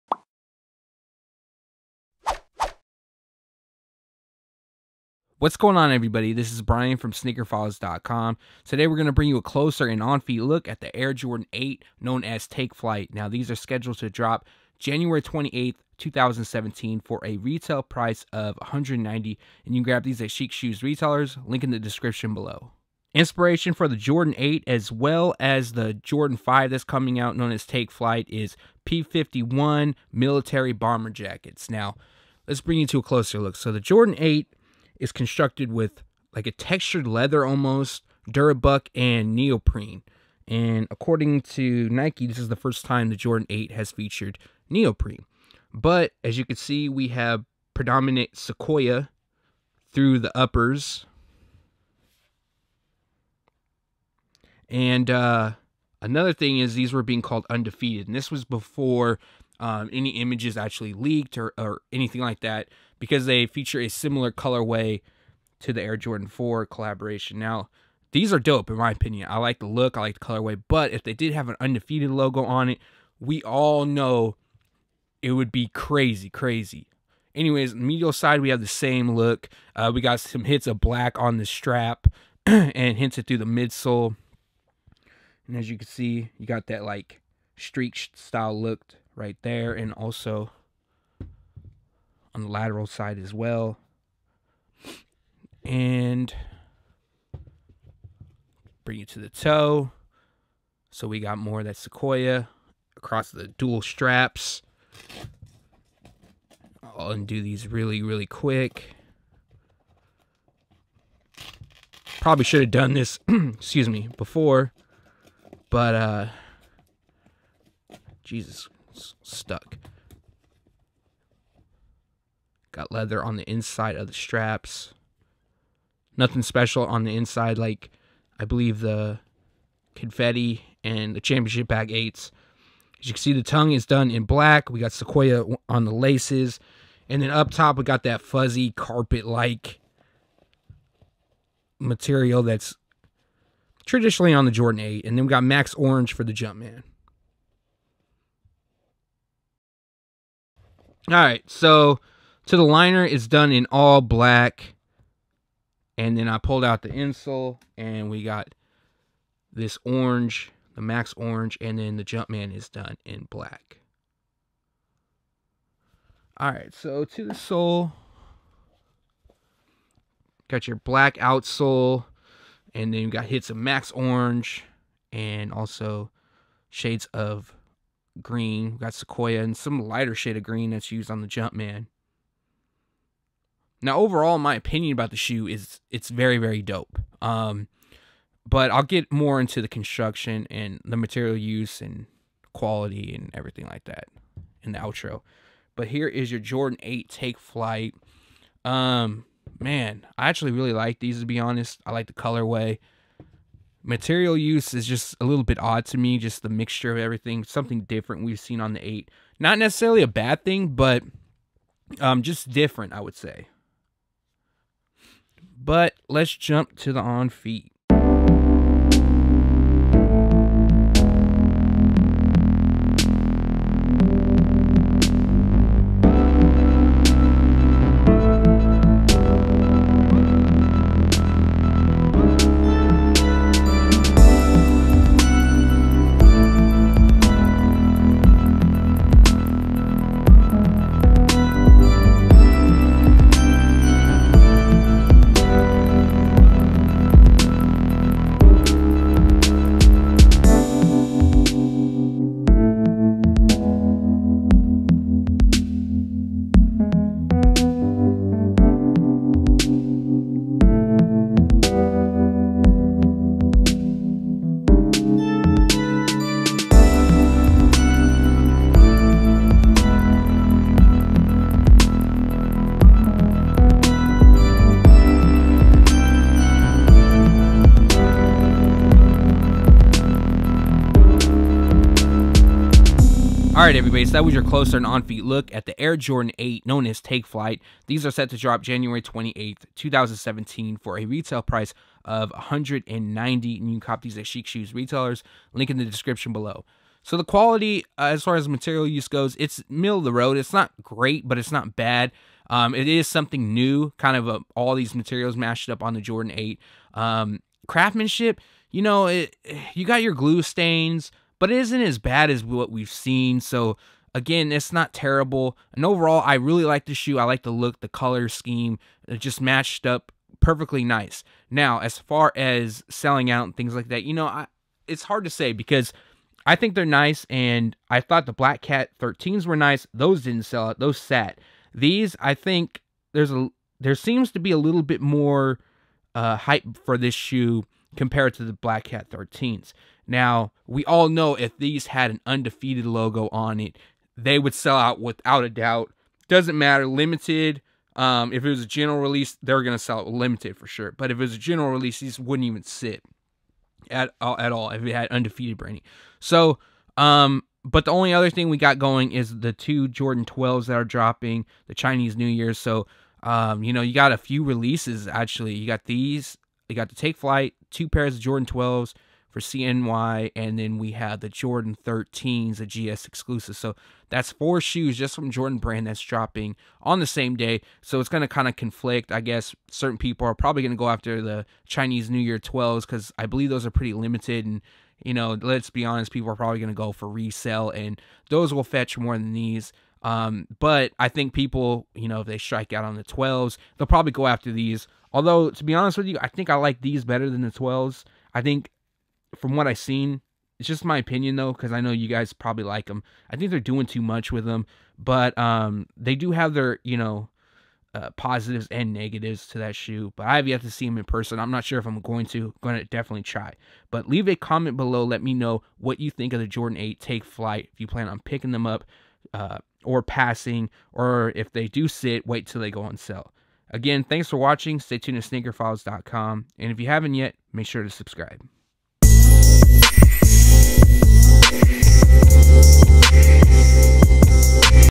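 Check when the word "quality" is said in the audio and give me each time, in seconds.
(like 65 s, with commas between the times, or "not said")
192 s, 297 s.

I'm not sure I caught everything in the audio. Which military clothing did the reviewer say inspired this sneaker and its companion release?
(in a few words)
P51 military bomber jackets.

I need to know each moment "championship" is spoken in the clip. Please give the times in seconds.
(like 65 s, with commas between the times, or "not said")
131 s.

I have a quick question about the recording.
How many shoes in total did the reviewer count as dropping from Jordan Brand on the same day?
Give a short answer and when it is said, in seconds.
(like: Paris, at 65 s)
4, at 374 s.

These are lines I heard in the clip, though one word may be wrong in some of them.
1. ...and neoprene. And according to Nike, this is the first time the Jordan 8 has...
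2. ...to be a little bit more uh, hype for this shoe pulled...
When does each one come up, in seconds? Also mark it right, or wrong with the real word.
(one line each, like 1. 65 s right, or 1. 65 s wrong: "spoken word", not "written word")
1. 38 s right
2. 334 s wrong: "compared", not "pulled".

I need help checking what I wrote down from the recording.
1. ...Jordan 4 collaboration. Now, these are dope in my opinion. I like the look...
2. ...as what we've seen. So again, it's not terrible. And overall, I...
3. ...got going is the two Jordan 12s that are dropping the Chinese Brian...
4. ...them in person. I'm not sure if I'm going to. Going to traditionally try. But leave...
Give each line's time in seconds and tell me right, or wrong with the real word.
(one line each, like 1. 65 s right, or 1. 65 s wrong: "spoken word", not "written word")
1. 65 s right
2. 312 s right
3. 358 s wrong: "New", not "Brian"
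4. 410 s wrong: "definitely", not "traditionally".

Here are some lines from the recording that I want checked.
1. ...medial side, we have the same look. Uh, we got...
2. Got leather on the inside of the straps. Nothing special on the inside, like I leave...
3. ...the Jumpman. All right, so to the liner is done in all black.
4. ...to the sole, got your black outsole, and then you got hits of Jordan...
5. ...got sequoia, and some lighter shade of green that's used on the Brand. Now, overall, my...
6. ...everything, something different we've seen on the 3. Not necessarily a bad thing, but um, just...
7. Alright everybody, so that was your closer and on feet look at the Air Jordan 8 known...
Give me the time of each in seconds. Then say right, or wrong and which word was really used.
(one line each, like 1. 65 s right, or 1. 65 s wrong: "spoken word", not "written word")
1. 77 s right
2. 122 s wrong: "believe", not "leave"
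3. 146 s right
4. 167 s wrong: "Max", not "Jordan"
5. 178 s wrong: "Jumpman", not "Brand"
6. 206 s wrong: "8", not "3"
7. 283 s right.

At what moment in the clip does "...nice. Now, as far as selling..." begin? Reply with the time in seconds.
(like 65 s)
320 s.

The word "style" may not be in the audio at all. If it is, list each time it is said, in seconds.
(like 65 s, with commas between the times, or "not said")
88 s.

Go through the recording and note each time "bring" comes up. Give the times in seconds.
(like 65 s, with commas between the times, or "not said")
9 s, 32 s, 98 s.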